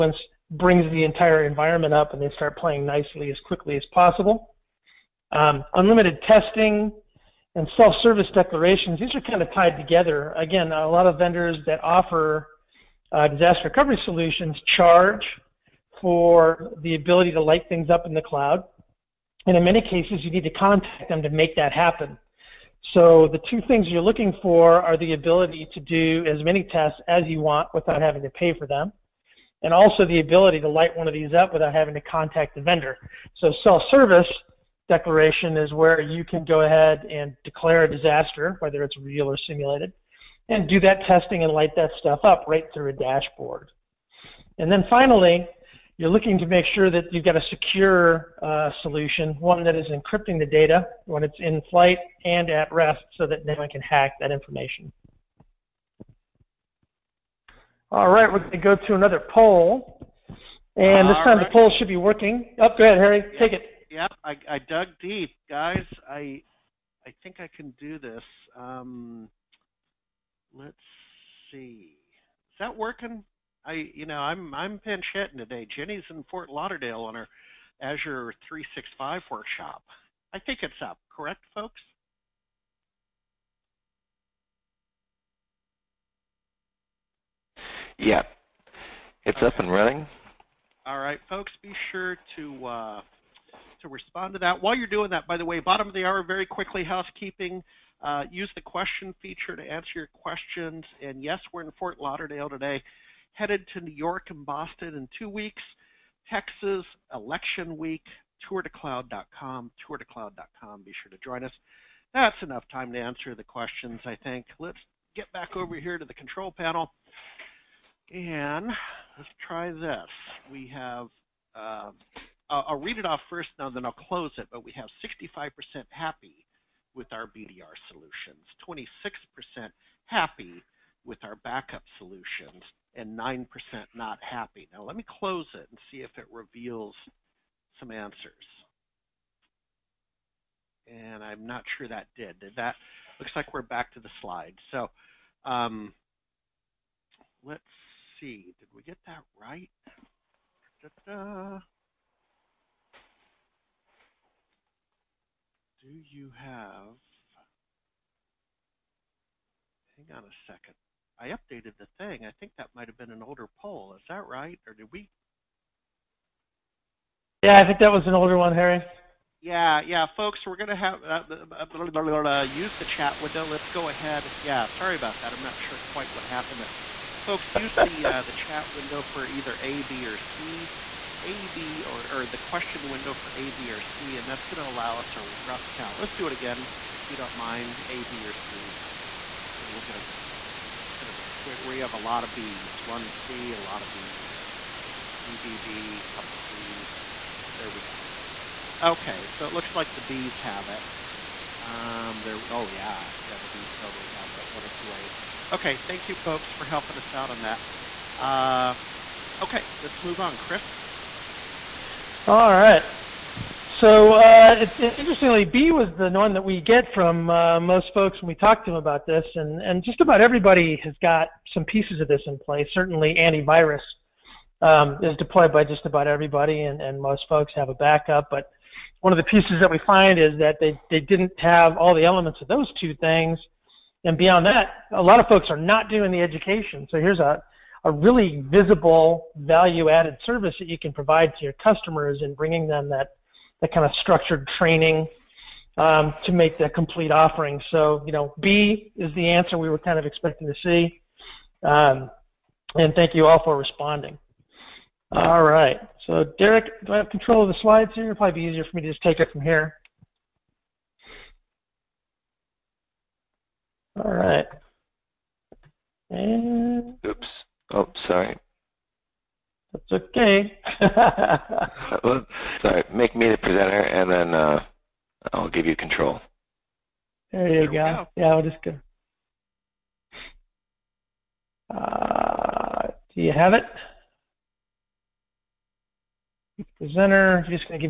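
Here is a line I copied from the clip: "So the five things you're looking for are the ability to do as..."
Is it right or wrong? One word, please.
wrong.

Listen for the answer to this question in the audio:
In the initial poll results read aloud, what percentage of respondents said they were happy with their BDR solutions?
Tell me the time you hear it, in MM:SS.
02:05.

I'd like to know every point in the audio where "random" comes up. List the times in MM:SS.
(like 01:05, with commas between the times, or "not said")
not said.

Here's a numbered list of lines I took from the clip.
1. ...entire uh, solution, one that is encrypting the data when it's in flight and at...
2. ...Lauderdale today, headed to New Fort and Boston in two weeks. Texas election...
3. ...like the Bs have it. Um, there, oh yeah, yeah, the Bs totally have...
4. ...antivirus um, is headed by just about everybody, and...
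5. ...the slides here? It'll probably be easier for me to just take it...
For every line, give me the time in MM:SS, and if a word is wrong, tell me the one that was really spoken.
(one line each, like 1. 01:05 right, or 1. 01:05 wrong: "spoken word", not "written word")
1. 00:47 wrong: "secure", not "entire"
2. 01:42 wrong: "York", not "Fort"
3. 03:19 right
4. 03:43 wrong: "deployed", not "headed"
5. 04:17 right.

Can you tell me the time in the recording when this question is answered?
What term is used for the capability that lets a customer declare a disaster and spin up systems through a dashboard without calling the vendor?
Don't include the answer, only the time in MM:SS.
00:33.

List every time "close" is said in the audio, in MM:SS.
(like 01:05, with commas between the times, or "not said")
02:04, 02:15.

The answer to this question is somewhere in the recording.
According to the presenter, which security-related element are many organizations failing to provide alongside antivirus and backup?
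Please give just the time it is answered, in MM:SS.
03:56.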